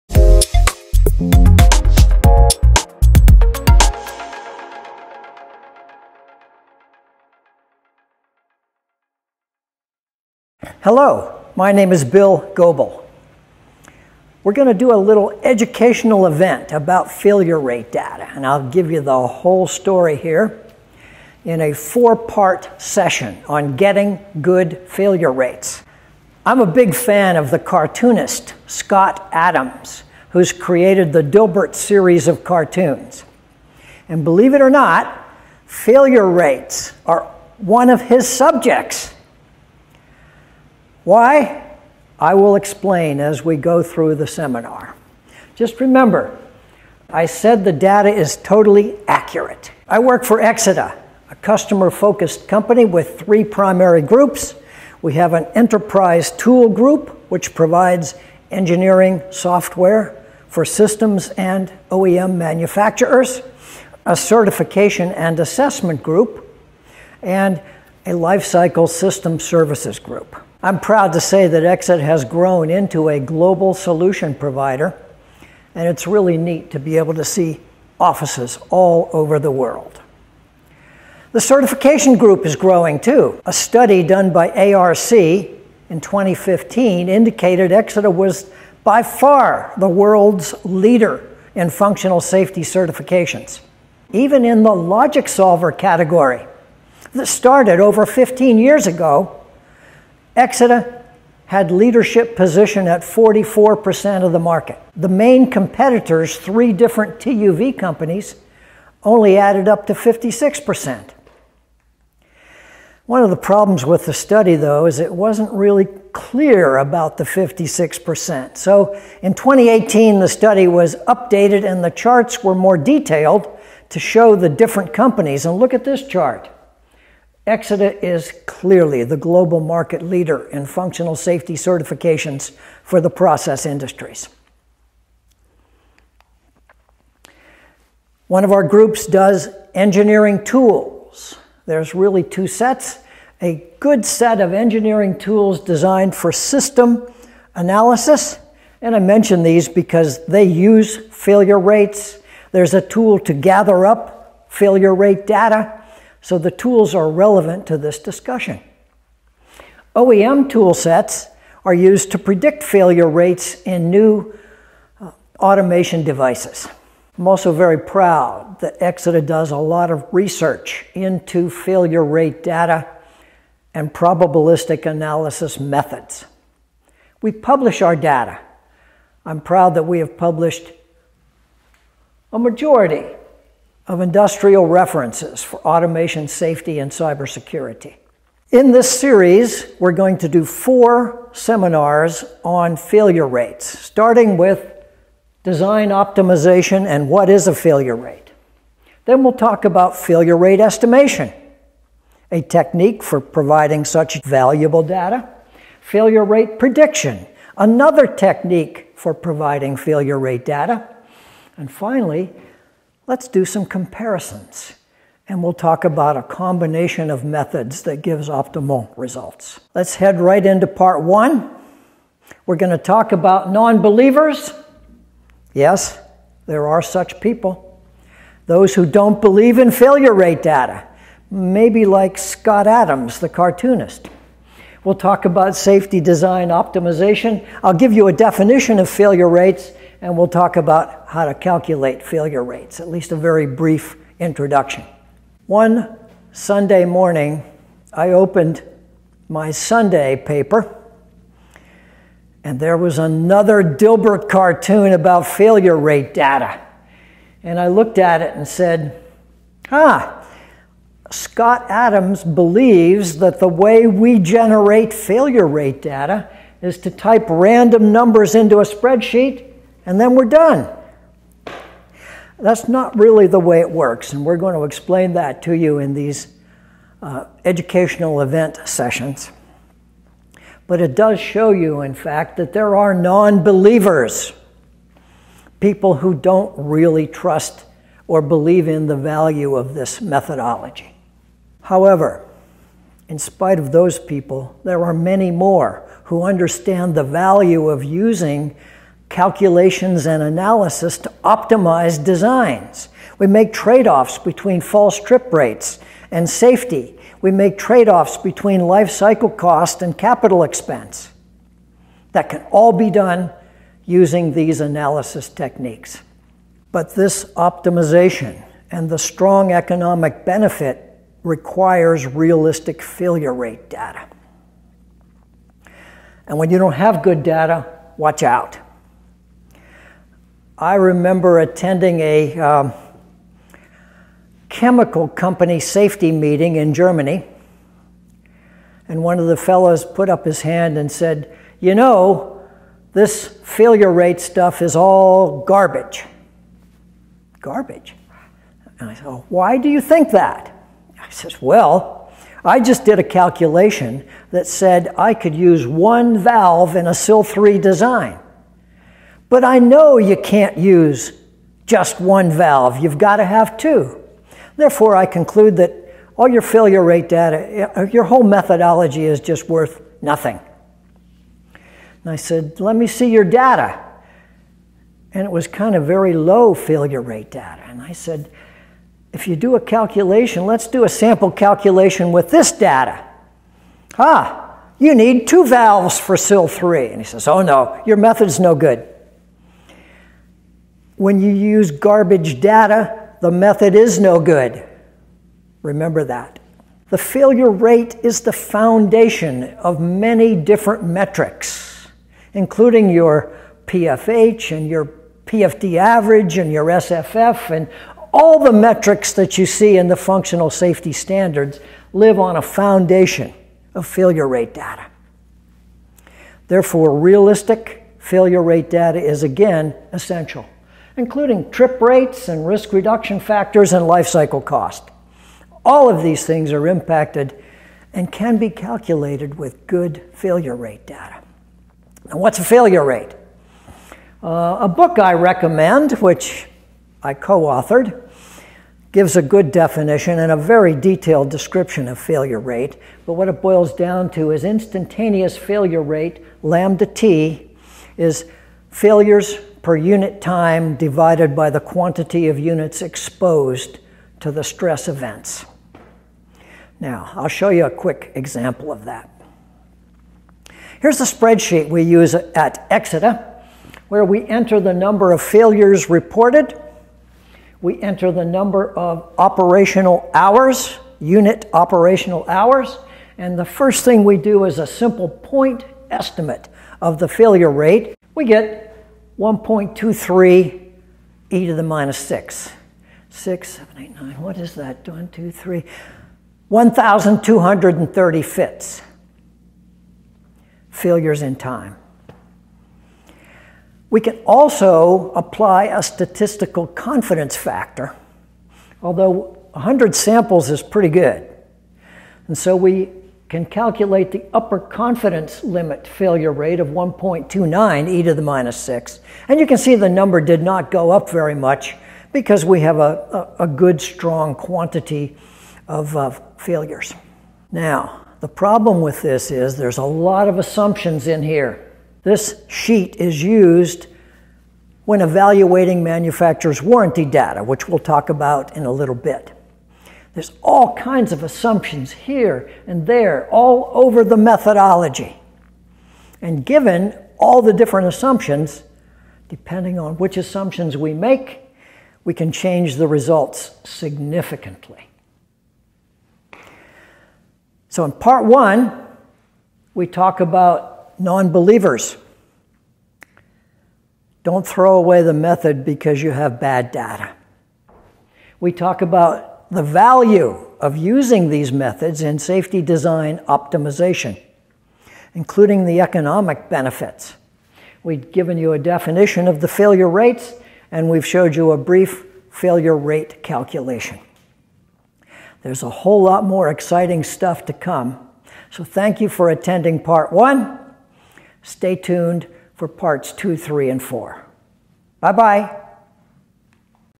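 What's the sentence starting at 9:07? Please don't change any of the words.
So in part one, we talk about non believers.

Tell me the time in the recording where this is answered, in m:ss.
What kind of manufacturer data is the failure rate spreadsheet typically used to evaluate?
8:46.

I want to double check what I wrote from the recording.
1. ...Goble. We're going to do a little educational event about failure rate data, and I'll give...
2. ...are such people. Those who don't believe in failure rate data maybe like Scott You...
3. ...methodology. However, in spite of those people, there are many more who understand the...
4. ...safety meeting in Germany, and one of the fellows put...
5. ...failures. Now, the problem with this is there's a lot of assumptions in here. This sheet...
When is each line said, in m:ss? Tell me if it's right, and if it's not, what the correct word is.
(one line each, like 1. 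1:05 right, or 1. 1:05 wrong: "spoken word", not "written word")
1. 0:12 right
2. 3:46 wrong: "Adams", not "You"
3. 4:50 right
4. 5:35 right
5. 8:36 right.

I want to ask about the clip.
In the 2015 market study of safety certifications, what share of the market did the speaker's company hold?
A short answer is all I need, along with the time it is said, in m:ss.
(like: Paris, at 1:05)
44%, at 1:43.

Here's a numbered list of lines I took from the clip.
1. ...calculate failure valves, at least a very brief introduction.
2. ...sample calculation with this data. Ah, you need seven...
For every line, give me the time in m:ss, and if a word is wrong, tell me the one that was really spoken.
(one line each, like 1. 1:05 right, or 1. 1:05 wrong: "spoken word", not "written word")
1. 4:01 wrong: "rates", not "valves"
2. 6:20 wrong: "two", not "seven".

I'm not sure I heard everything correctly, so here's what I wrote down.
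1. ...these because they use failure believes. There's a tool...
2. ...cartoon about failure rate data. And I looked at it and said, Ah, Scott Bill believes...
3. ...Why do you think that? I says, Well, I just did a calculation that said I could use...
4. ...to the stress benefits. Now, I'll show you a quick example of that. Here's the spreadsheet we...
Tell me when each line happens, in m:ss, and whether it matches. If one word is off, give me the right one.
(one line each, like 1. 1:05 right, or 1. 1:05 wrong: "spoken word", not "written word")
1. 2:29 wrong: "rates", not "believes"
2. 4:14 wrong: "Adams", not "Bill"
3. 5:49 right
4. 7:34 wrong: "events", not "benefits".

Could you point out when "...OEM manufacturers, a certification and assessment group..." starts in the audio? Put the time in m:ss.
1:01.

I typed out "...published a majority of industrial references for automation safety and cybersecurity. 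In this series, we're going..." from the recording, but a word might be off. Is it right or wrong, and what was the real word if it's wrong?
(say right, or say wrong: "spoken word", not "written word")
right.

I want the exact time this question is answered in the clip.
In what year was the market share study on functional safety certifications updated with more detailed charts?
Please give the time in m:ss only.
1:59.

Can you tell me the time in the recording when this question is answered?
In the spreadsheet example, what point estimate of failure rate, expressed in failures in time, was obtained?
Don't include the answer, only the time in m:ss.
8:06.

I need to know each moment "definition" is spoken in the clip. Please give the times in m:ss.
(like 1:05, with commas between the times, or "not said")
3:58, 7:19, 9:28.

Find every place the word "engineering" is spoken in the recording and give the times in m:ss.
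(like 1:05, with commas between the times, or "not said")
0:58, 2:19, 2:24.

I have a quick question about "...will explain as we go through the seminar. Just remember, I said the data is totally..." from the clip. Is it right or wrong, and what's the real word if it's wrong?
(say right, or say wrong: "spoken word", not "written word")
right.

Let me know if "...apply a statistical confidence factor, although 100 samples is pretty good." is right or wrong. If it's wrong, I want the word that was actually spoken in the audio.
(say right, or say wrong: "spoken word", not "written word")
right.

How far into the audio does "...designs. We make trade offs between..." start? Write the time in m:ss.
5:02.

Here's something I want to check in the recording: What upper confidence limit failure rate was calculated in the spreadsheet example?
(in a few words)
1.29e-6.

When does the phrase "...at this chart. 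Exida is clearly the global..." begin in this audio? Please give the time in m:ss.
2:05.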